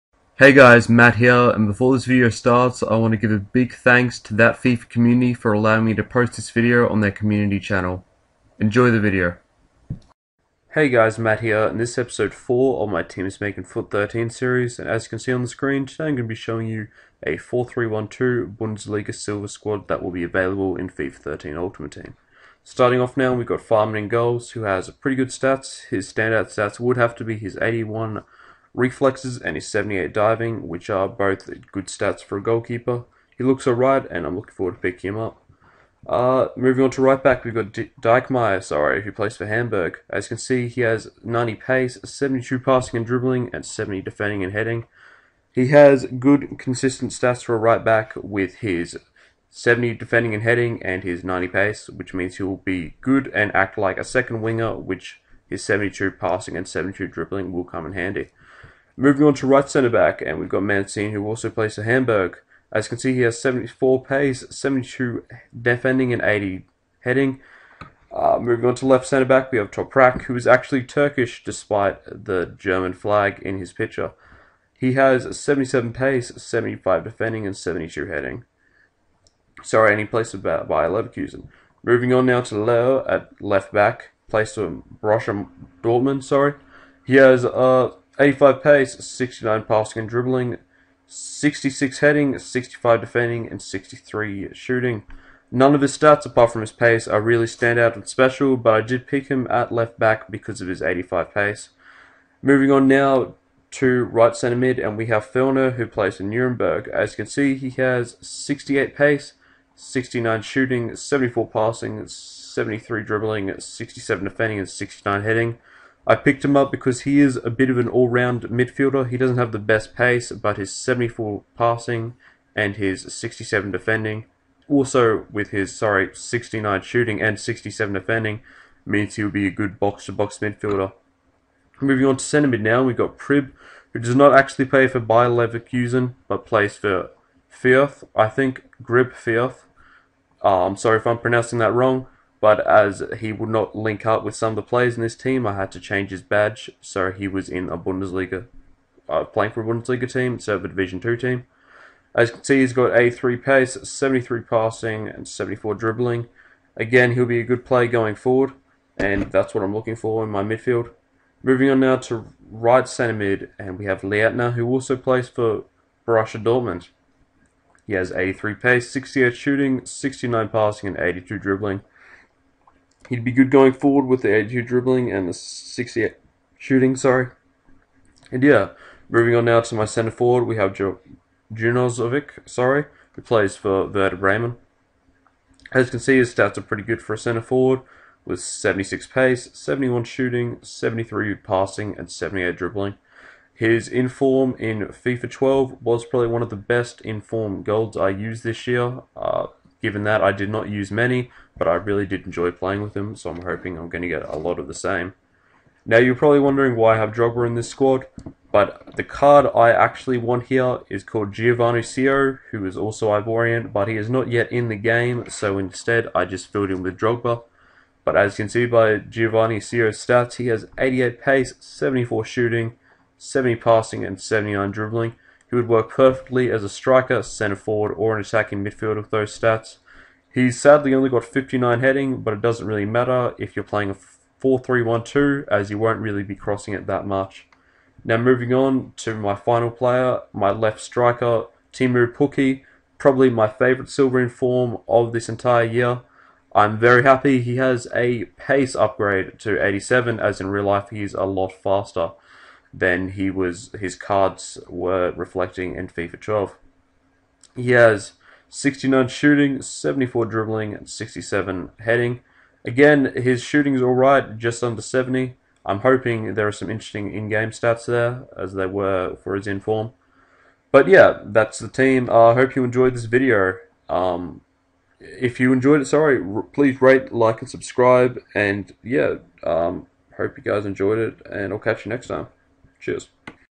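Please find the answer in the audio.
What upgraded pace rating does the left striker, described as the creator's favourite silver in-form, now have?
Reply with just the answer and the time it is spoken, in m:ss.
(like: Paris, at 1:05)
87, at 4:09.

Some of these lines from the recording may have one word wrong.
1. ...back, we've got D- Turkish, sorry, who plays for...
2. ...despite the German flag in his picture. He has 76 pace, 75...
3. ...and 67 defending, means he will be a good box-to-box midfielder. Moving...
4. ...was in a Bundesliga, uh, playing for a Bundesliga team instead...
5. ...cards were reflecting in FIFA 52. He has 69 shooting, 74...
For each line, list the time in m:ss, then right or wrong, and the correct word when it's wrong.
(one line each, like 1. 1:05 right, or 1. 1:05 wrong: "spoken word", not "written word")
1. 0:37 wrong: "Diekmeier", not "Turkish"
2. 1:11 wrong: "77", not "76"
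3. 2:07 right
4. 2:27 right
5. 4:13 wrong: "12", not "52".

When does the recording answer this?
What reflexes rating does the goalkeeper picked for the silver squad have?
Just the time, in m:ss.
0:27.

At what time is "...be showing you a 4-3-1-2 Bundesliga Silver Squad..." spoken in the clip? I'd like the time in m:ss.
0:16.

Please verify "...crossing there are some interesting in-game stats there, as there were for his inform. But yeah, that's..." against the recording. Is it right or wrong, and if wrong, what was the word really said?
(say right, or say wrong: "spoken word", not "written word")
wrong: "hoping", not "crossing".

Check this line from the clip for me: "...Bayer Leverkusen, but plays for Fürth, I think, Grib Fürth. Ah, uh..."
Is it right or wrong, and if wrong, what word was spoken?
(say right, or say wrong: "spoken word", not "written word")
right.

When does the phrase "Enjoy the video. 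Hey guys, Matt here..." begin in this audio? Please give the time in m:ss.
0:08.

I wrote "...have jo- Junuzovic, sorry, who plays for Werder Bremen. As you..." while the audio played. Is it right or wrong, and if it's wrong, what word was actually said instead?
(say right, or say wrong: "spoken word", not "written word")
right.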